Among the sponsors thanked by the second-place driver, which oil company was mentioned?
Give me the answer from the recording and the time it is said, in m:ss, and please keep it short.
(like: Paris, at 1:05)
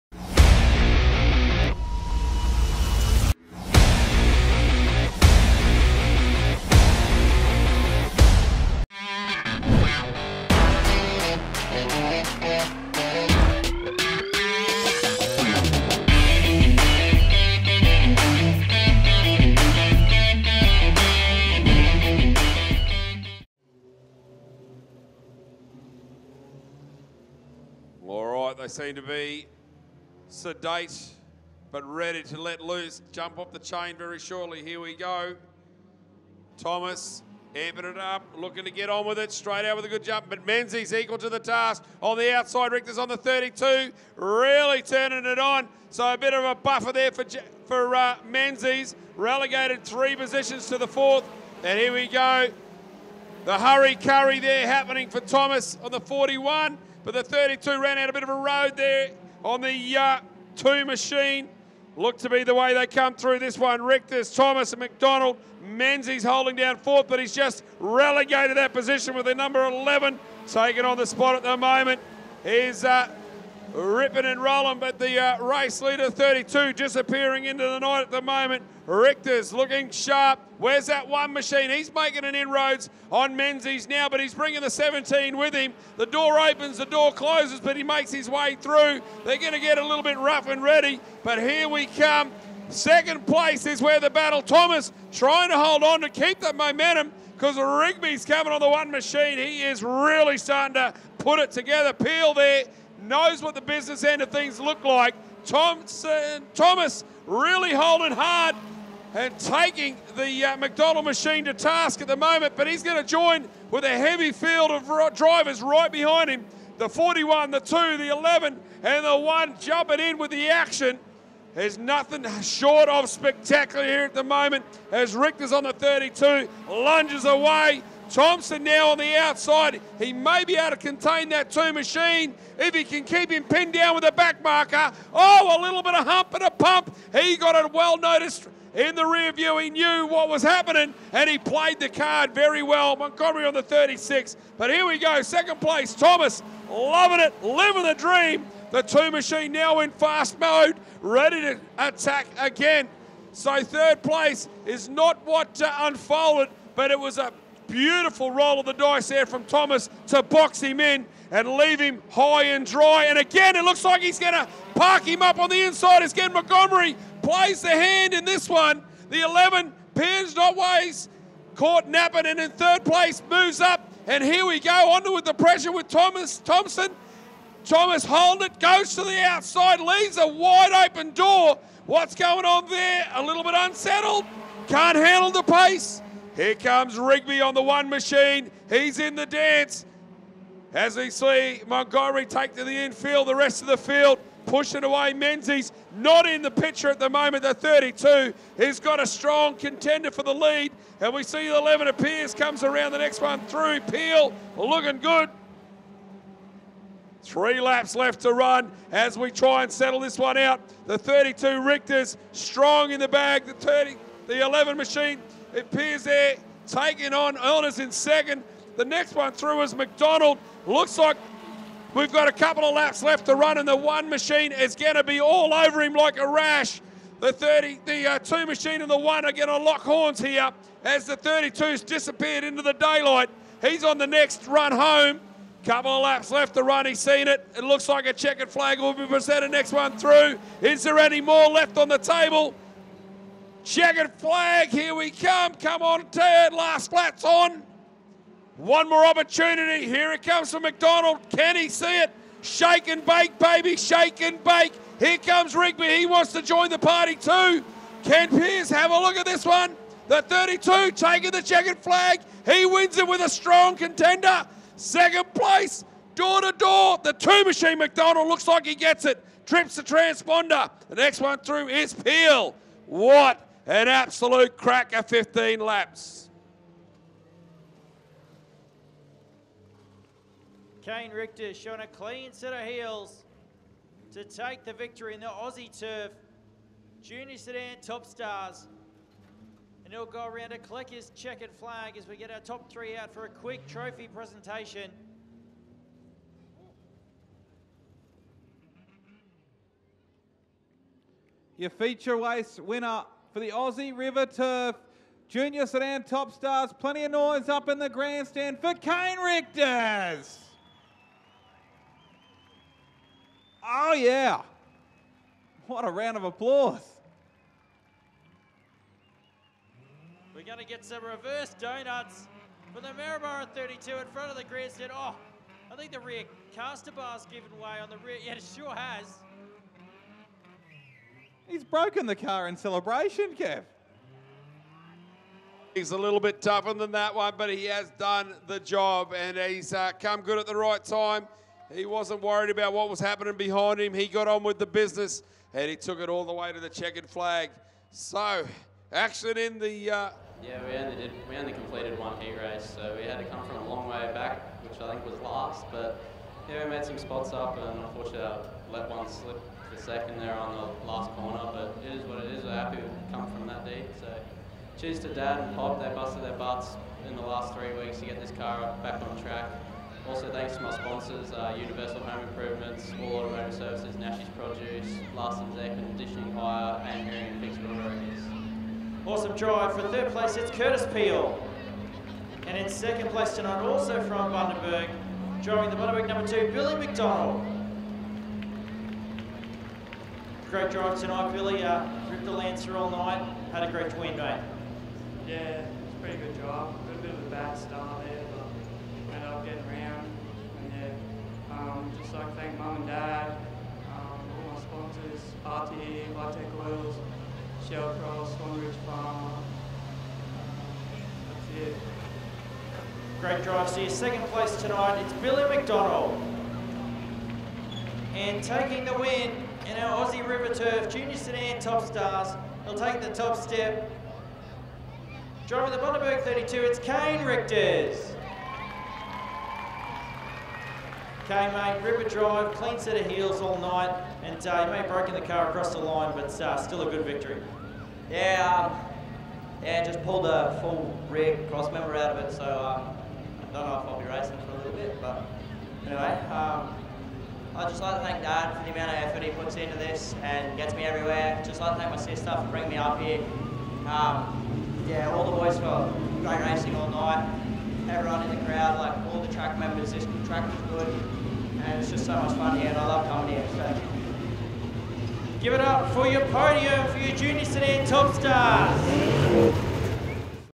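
Vitec Oils, at 6:46.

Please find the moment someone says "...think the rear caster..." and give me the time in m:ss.
5:25.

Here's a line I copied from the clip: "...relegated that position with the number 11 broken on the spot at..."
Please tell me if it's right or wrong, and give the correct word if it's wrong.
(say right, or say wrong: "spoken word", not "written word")
wrong: "taken", not "broken".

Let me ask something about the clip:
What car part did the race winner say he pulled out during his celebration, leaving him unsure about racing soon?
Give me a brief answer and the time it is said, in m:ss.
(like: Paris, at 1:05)
Full rear cross member, at 7:20.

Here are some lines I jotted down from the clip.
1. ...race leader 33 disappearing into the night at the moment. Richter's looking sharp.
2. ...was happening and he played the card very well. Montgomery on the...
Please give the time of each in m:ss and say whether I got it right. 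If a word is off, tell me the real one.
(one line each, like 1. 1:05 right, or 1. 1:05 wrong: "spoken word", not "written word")
1. 1:15 wrong: "32", not "33"
2. 2:20 right.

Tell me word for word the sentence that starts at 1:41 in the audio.
Peel there knows what the business end of things look like.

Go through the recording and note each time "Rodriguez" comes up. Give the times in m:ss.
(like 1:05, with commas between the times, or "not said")
6:17.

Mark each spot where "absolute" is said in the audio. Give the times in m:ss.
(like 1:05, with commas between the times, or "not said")
4:33.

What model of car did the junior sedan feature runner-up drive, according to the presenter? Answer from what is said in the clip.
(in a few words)
Lancer.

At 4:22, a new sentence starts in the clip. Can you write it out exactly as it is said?
He wins it with a strong contender.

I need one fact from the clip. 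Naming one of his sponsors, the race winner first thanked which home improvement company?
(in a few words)
Universal Home Improvements.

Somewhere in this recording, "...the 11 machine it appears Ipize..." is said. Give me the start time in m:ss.
3:34.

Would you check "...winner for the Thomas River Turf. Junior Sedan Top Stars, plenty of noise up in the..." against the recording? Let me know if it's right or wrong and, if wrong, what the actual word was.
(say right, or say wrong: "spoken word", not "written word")
wrong: "Aussie", not "Thomas".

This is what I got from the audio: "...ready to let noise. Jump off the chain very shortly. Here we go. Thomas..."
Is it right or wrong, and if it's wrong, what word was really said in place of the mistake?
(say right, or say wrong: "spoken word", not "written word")
wrong: "loose", not "noise".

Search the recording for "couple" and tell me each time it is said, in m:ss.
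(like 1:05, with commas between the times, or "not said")
3:42, 3:55.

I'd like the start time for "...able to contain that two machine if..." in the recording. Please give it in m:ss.
2:10.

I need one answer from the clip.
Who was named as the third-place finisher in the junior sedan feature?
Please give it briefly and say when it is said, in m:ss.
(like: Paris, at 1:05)
Curtis Peel, at 6:20.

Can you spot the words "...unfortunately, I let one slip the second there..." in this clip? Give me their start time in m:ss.
5:57.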